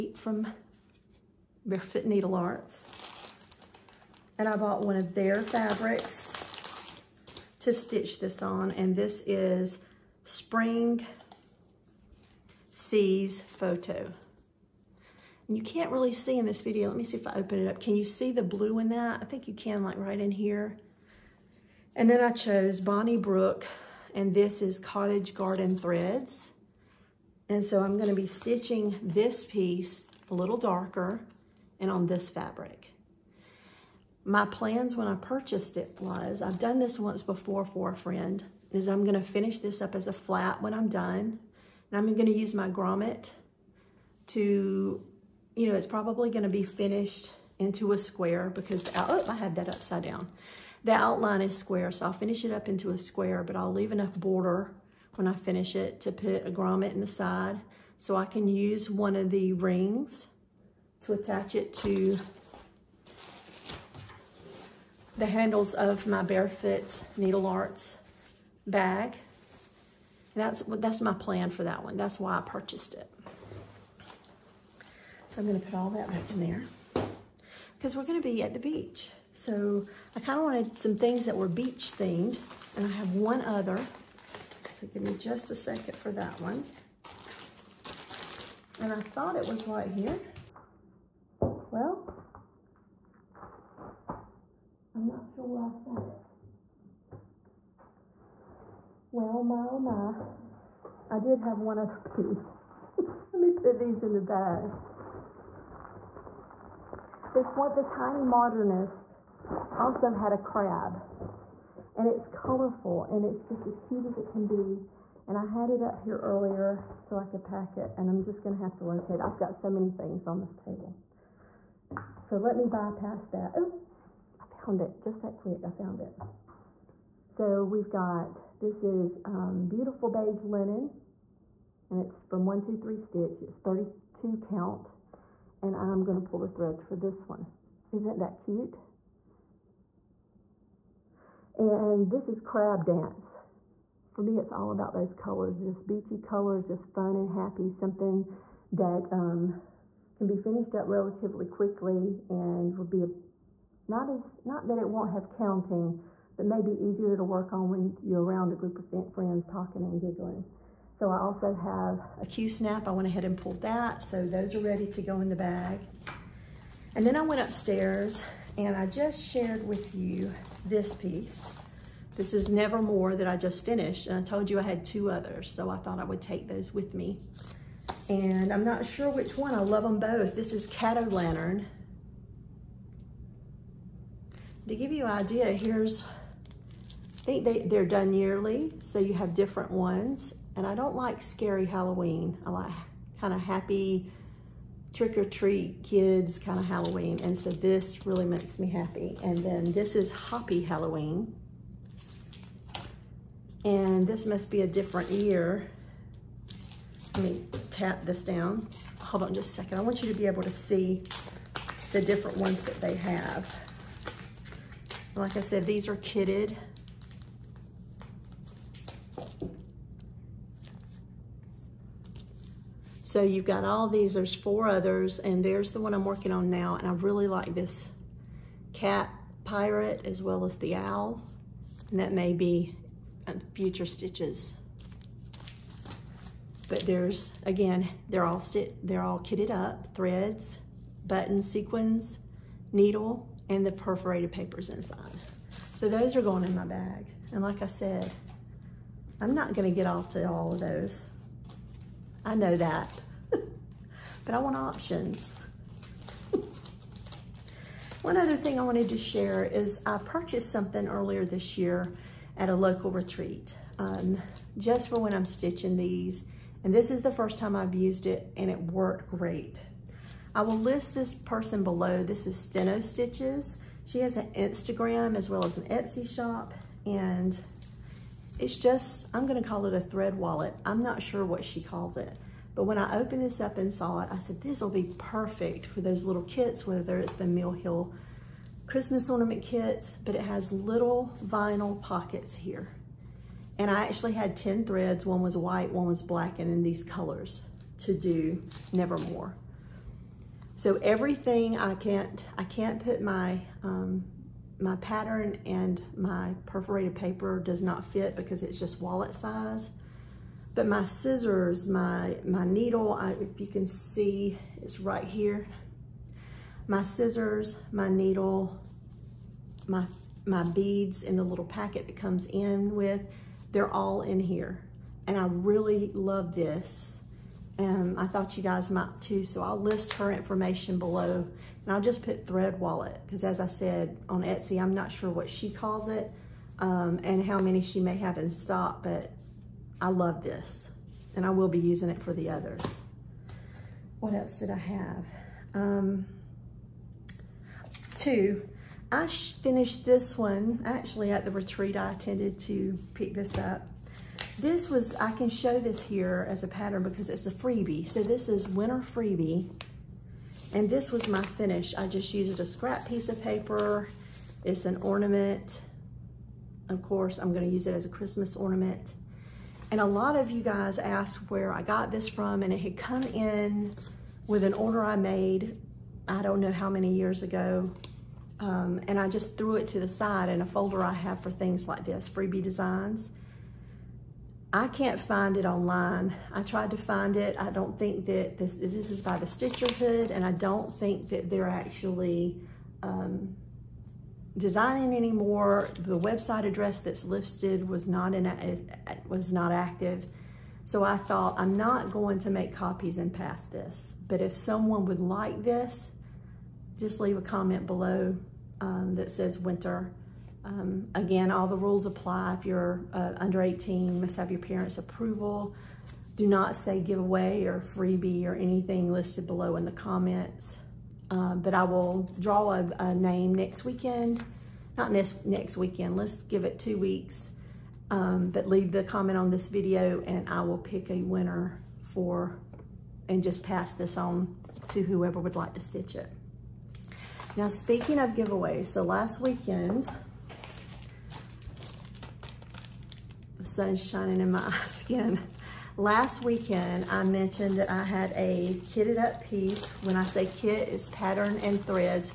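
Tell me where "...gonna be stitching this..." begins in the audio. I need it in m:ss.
0:27.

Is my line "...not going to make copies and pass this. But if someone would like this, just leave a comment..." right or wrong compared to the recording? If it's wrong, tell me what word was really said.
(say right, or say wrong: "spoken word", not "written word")
right.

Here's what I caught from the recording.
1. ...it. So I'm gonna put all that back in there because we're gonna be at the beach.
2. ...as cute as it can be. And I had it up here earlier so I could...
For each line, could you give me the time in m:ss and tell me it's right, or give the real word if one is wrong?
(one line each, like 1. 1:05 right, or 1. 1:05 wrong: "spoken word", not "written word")
1. 1:12 right
2. 1:53 right.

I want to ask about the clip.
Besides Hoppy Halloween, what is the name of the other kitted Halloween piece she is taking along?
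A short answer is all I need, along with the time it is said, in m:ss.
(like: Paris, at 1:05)
Cato Lantern, at 3:00.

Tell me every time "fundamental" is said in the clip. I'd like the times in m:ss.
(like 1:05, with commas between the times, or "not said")
not said.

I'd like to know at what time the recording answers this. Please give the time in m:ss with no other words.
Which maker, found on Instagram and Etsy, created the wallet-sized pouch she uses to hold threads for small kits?
4:32.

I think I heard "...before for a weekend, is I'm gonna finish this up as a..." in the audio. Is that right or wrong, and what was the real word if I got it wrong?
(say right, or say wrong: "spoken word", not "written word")
wrong: "friend", not "weekend".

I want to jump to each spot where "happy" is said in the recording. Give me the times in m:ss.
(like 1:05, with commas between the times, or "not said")
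2:27, 3:13, 3:18.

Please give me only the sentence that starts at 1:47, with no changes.
It's what the tiny modernist also had a crab.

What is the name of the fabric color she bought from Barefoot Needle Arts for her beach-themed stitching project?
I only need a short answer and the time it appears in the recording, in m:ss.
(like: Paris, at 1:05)
Spring Seas, at 0:10.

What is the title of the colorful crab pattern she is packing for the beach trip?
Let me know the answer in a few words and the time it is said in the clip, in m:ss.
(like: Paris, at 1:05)
Crab Dance, at 2:22.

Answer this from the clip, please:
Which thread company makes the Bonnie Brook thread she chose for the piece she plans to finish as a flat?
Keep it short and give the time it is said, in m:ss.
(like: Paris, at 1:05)
Cottage Garden Threads, at 0:24.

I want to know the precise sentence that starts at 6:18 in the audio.
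Um, and I just threw it to the side in a folder I have for things like this, freebie designs.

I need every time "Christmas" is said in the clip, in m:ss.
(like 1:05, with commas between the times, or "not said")
4:48, 6:07.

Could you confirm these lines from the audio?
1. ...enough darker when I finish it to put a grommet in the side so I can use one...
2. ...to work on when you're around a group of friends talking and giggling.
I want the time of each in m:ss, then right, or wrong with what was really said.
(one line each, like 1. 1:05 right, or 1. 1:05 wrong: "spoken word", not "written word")
1. 0:53 wrong: "border", not "darker"
2. 2:37 right.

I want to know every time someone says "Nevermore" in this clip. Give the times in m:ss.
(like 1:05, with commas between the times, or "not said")
2:52, 4:58.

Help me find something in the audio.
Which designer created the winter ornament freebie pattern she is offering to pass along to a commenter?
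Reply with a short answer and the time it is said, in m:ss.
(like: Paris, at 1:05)
The Stitcherhood, at 6:29.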